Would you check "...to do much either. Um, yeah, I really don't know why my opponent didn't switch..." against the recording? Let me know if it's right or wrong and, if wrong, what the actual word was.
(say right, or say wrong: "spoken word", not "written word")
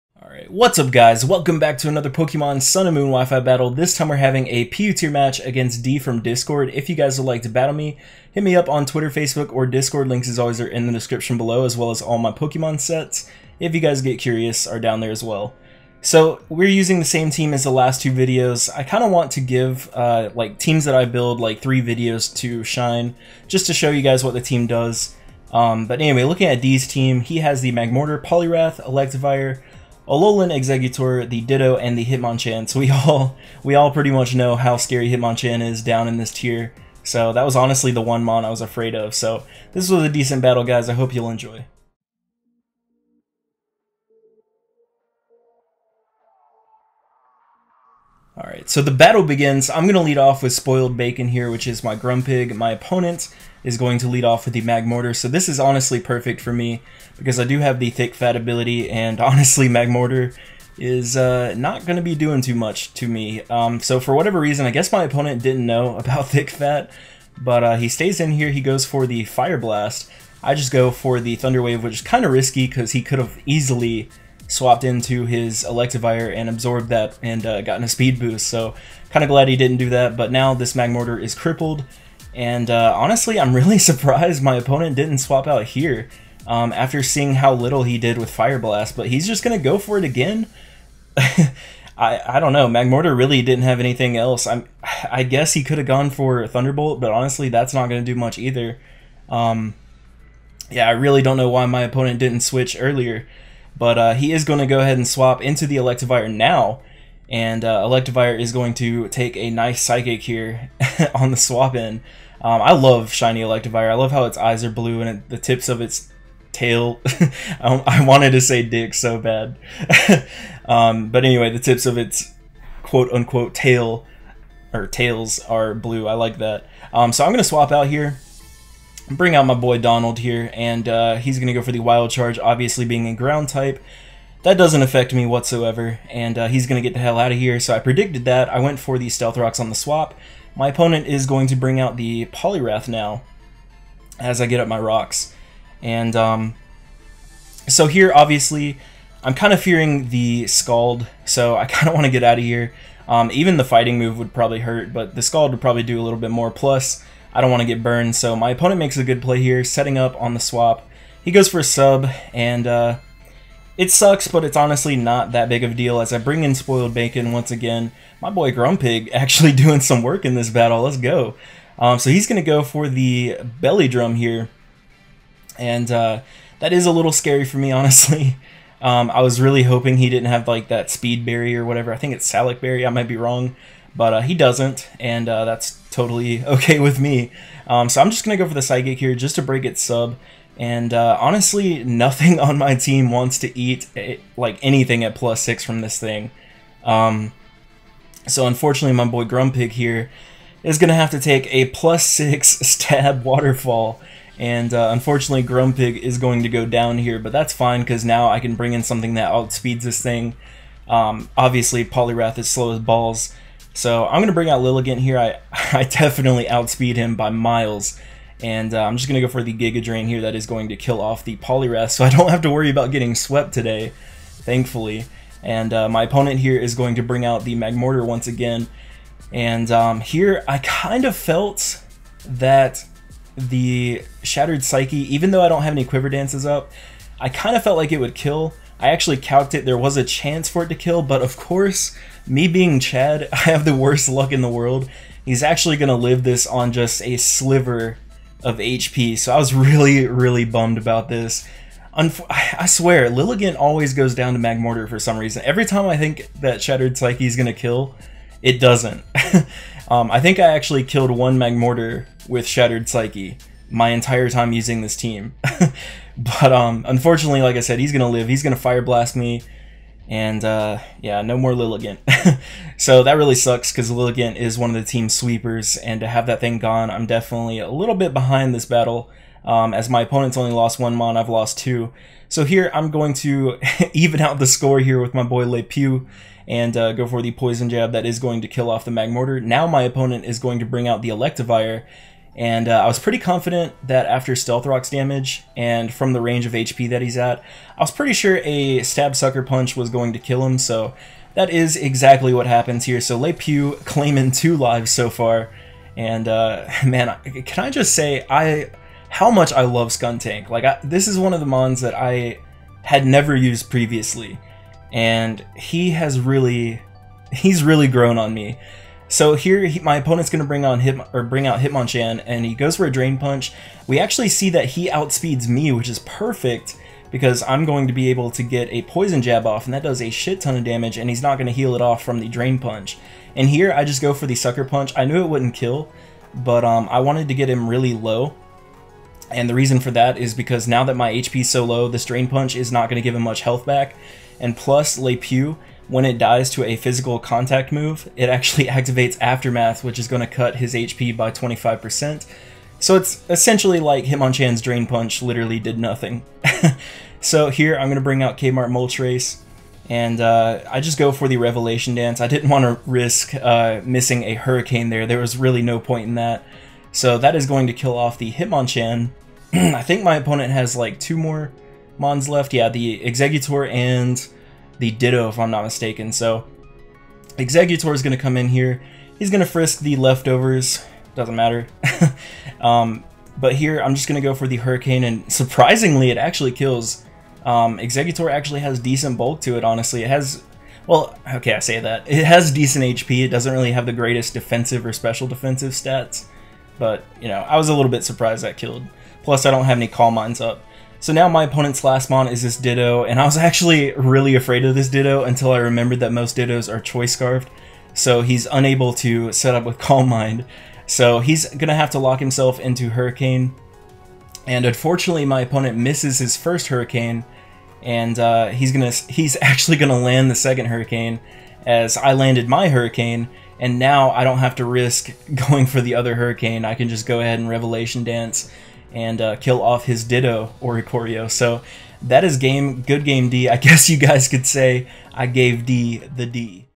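right.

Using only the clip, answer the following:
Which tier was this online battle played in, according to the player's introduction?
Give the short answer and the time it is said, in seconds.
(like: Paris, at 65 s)
PU, at 4 s.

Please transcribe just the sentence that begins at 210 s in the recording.
Um, obviously, Poliwrath is slow as balls, so I'm going to bring out Lilligant here.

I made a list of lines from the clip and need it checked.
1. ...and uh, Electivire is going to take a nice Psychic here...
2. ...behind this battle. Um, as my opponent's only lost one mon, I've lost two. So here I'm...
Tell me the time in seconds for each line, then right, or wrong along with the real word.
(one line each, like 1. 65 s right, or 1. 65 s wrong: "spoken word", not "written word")
1. 107 s right
2. 278 s right.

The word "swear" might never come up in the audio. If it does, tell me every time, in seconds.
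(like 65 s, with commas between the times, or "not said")
252 s.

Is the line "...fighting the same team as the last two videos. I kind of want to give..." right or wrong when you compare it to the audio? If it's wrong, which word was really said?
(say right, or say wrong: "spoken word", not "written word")
wrong: "using", not "fighting".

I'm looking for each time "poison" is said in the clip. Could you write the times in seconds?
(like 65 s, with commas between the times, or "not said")
287 s, 328 s.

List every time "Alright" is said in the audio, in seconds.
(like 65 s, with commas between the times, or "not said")
0 s, 48 s.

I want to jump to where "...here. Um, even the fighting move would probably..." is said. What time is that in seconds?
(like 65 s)
152 s.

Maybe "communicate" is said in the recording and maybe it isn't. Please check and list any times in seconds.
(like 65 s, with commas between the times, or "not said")
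not said.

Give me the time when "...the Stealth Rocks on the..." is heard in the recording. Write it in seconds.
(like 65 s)
138 s.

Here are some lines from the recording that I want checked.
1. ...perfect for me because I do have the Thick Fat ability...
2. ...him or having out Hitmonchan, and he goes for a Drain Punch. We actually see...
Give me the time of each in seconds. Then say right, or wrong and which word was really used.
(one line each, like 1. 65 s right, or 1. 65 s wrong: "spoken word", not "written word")
1. 55 s right
2. 320 s wrong: "bring", not "having".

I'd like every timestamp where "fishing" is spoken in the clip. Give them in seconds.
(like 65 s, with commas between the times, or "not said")
not said.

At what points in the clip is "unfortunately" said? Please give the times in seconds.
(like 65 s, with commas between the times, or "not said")
198 s, 204 s, 266 s, 414 s.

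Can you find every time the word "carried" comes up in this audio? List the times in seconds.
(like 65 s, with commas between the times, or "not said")
not said.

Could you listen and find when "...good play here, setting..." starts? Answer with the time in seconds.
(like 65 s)
159 s.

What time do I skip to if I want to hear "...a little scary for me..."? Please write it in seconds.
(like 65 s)
176 s.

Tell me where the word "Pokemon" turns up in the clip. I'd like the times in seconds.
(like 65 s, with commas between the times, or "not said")
2 s, 12 s.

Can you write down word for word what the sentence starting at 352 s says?
So it's essentially like Hitmonchan's Drain Punch literally did nothing.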